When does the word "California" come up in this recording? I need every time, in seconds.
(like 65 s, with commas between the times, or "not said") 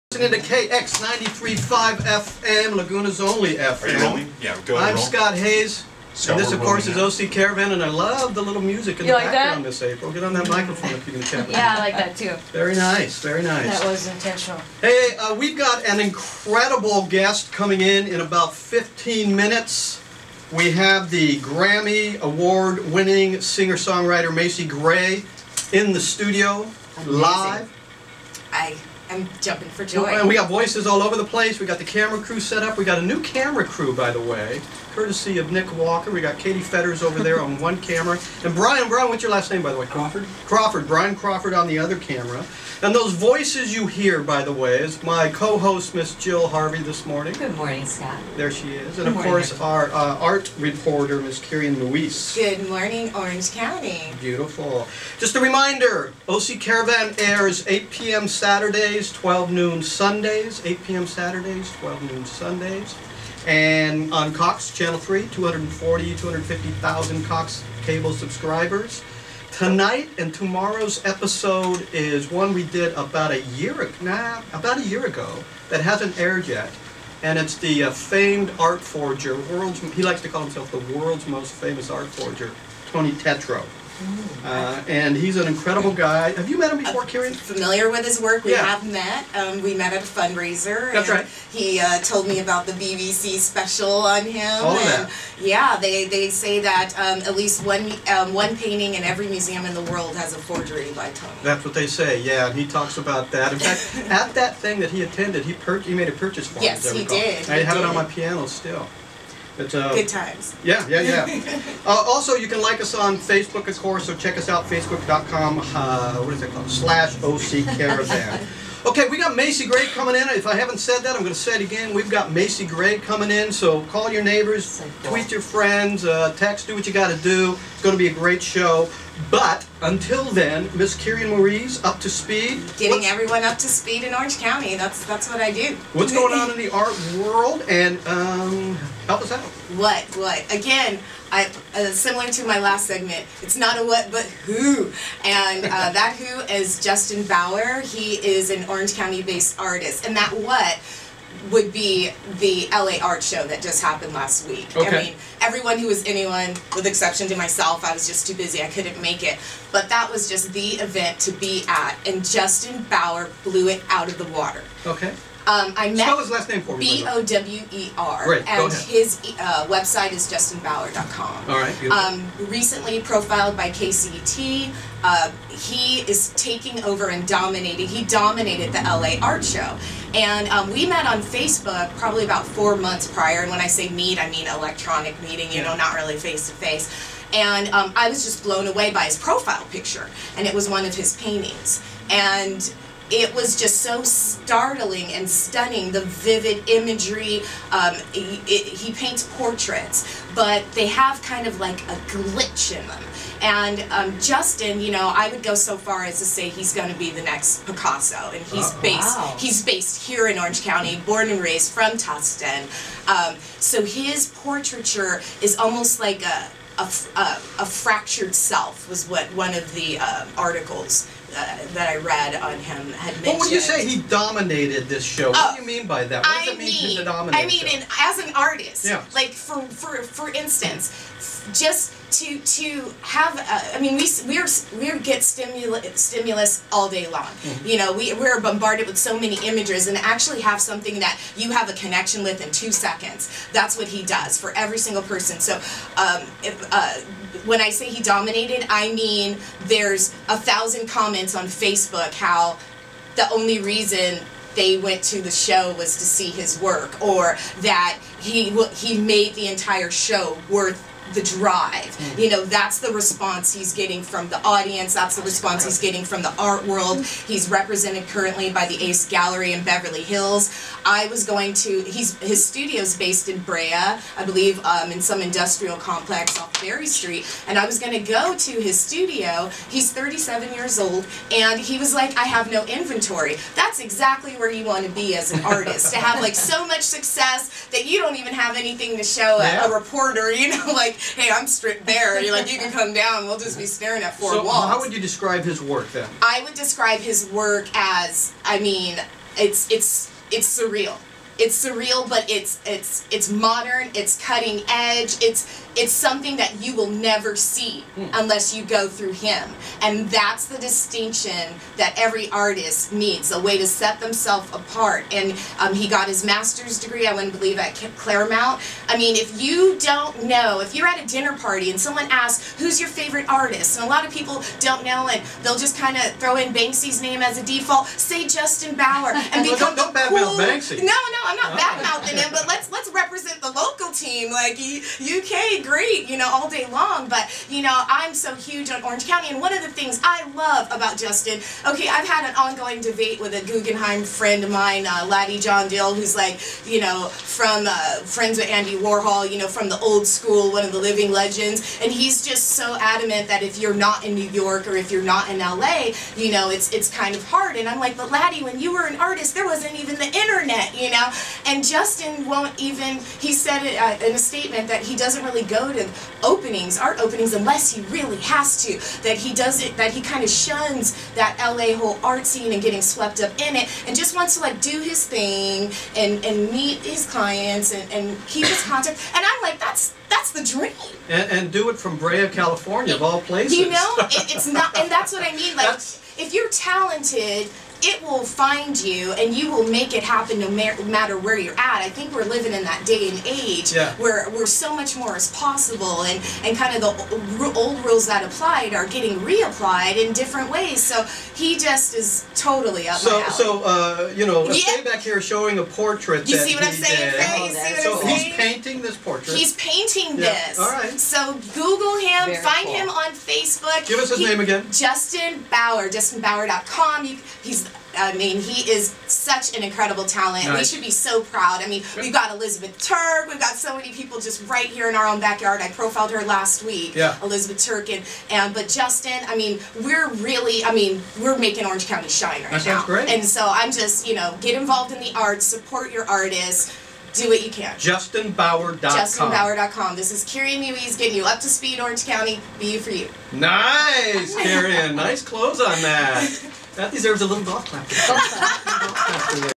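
382 s.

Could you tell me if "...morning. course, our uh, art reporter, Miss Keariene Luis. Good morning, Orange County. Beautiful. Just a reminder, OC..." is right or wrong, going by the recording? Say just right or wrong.
right.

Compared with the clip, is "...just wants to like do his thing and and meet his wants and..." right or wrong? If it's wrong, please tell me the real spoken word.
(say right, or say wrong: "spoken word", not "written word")
wrong: "clients", not "wants".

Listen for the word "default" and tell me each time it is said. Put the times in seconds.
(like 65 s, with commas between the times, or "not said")
327 s.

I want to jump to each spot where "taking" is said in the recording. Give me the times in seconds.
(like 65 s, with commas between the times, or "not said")
176 s.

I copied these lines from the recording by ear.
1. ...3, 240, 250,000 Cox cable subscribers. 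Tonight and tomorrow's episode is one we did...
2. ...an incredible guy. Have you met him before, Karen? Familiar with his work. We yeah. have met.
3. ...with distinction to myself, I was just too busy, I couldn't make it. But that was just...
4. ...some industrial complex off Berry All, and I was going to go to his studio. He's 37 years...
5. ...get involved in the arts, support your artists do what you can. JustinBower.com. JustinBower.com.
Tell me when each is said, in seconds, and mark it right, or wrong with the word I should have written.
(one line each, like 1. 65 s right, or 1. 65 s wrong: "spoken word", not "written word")
1. 64 s right
2. 85 s right
3. 156 s wrong: "exception", not "distinction"
4. 275 s wrong: "Street", not "All"
5. 434 s right.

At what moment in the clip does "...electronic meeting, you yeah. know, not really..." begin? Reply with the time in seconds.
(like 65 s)
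184 s.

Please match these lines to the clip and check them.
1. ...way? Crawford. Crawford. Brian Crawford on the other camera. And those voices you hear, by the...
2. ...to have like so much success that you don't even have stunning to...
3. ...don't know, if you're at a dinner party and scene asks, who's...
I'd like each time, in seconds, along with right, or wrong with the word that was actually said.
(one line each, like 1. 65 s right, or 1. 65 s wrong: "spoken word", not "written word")
1. 39 s right
2. 285 s wrong: "anything", not "stunning"
3. 319 s wrong: "someone", not "scene".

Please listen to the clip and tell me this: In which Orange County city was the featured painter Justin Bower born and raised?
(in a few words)
Tustin.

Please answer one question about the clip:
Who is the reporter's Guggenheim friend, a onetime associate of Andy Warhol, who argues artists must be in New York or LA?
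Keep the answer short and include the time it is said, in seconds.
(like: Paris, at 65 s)
Laddie John Dill, at 345 s.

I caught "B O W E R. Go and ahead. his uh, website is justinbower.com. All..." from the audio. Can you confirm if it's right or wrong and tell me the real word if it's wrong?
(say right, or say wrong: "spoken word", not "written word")
right.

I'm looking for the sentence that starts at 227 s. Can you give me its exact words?
I mean, as an artist, yeah.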